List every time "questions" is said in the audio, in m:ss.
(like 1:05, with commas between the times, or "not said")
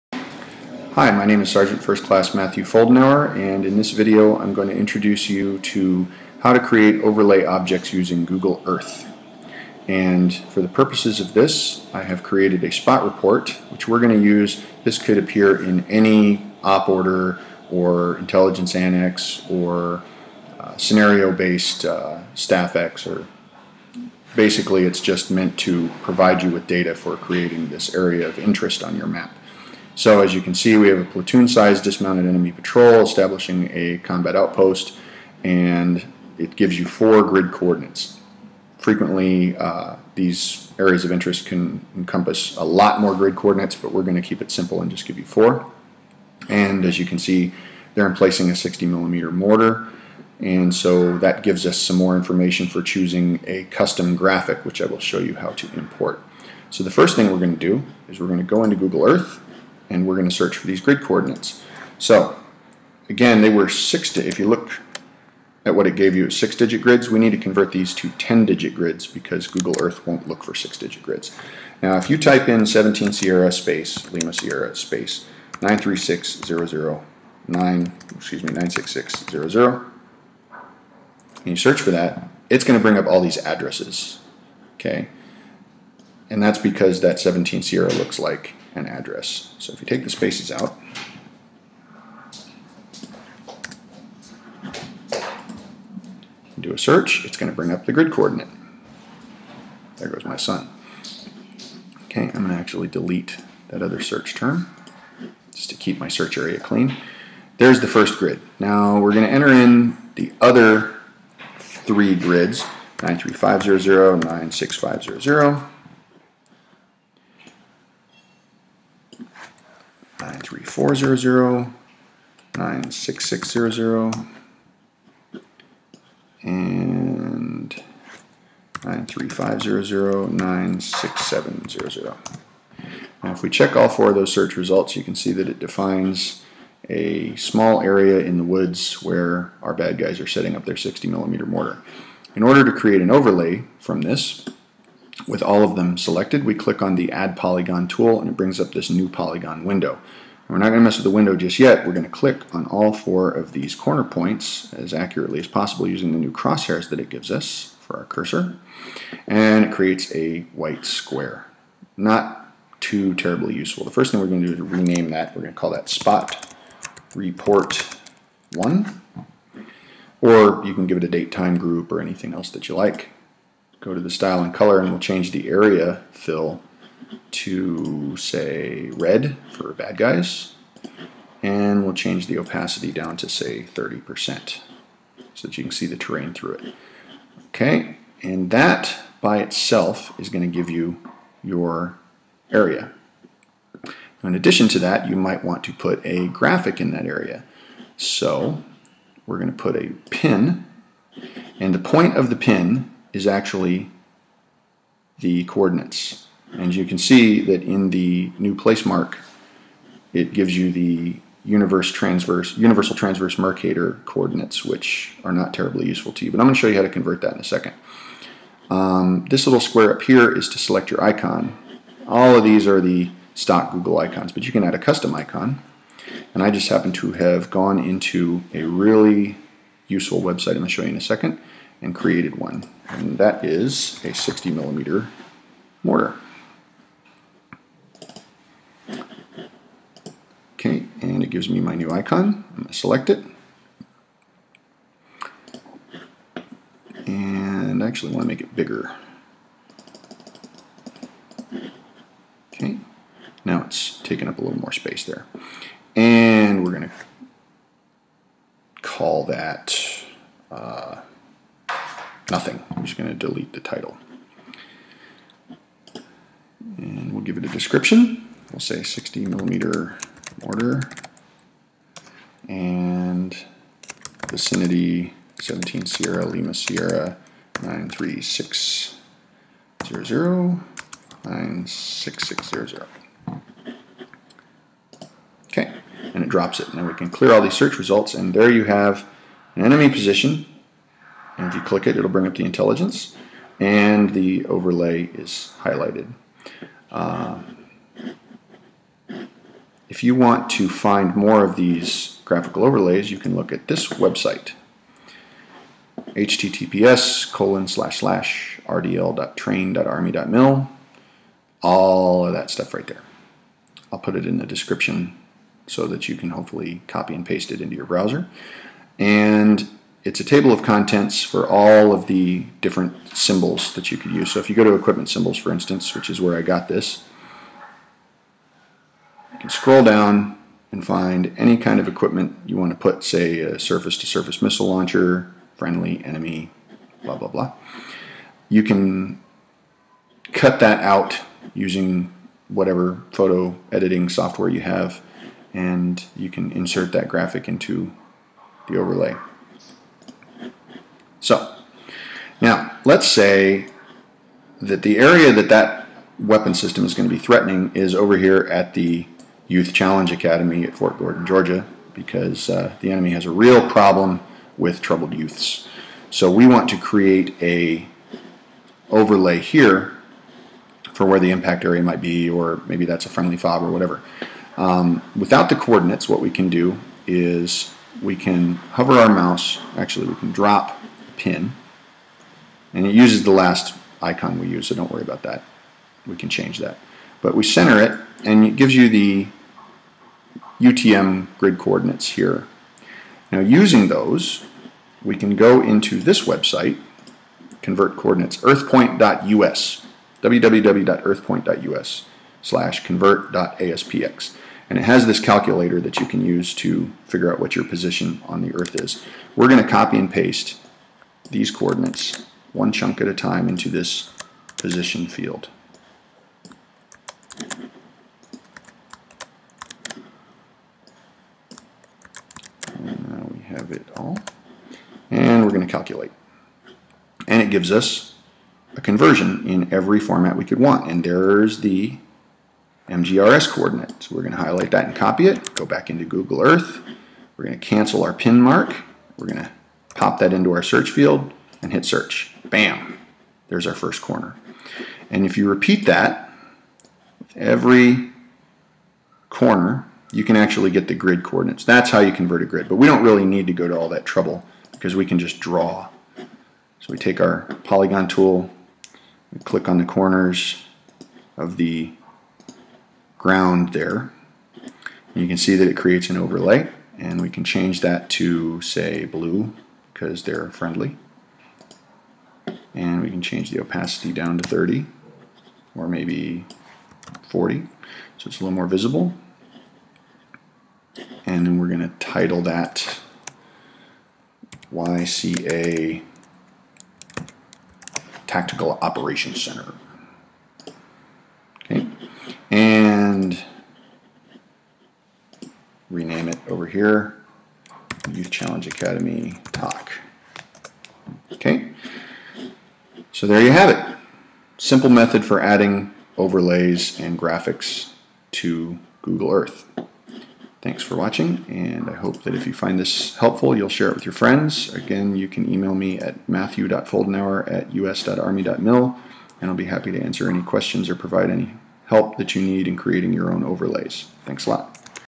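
8:40.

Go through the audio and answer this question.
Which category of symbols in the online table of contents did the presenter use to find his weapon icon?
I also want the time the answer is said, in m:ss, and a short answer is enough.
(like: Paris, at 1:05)
Equipment symbols, at 5:24.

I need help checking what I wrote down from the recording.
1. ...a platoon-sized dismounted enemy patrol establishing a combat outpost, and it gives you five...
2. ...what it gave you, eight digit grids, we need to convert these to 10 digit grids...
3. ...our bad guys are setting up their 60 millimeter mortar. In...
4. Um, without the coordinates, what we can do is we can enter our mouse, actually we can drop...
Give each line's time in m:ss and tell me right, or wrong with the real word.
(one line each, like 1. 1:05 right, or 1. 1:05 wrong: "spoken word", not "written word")
1. 0:30 wrong: "four", not "five"
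2. 1:05 wrong: "six", not "eight"
3. 2:19 right
4. 6:14 wrong: "hover", not "enter".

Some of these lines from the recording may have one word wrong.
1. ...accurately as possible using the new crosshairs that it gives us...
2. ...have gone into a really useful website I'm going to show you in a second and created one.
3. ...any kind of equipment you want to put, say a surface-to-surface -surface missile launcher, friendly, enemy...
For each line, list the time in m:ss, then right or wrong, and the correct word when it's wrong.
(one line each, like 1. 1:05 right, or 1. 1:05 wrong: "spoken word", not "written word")
1. 2:34 right
2. 3:47 right
3. 5:31 right.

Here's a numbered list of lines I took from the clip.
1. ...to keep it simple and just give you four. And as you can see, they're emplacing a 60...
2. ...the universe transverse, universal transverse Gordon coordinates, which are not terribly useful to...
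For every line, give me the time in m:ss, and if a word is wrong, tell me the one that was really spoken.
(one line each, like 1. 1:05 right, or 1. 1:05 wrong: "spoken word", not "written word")
1. 0:44 right
2. 3:30 wrong: "Mercator", not "Gordon".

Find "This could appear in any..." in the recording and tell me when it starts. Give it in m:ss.
0:14.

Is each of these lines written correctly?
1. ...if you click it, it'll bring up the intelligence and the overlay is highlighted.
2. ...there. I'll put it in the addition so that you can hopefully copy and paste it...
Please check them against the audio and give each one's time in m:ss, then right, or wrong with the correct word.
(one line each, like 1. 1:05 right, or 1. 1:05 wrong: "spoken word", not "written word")
1. 4:51 right
2. 5:12 wrong: "description", not "addition".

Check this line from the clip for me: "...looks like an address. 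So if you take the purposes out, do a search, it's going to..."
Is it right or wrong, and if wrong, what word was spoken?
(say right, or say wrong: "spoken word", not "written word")
wrong: "spaces", not "purposes".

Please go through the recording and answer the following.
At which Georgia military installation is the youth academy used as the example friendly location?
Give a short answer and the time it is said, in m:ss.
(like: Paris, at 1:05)
Fort Gordon, at 6:00.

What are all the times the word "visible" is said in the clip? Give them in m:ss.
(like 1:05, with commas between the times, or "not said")
7:58.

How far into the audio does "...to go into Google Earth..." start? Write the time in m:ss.
0:58.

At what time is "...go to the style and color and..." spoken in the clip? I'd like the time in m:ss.
2:53.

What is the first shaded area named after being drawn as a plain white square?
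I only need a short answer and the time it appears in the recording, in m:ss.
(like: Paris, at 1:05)
Spot Report 1, at 2:45.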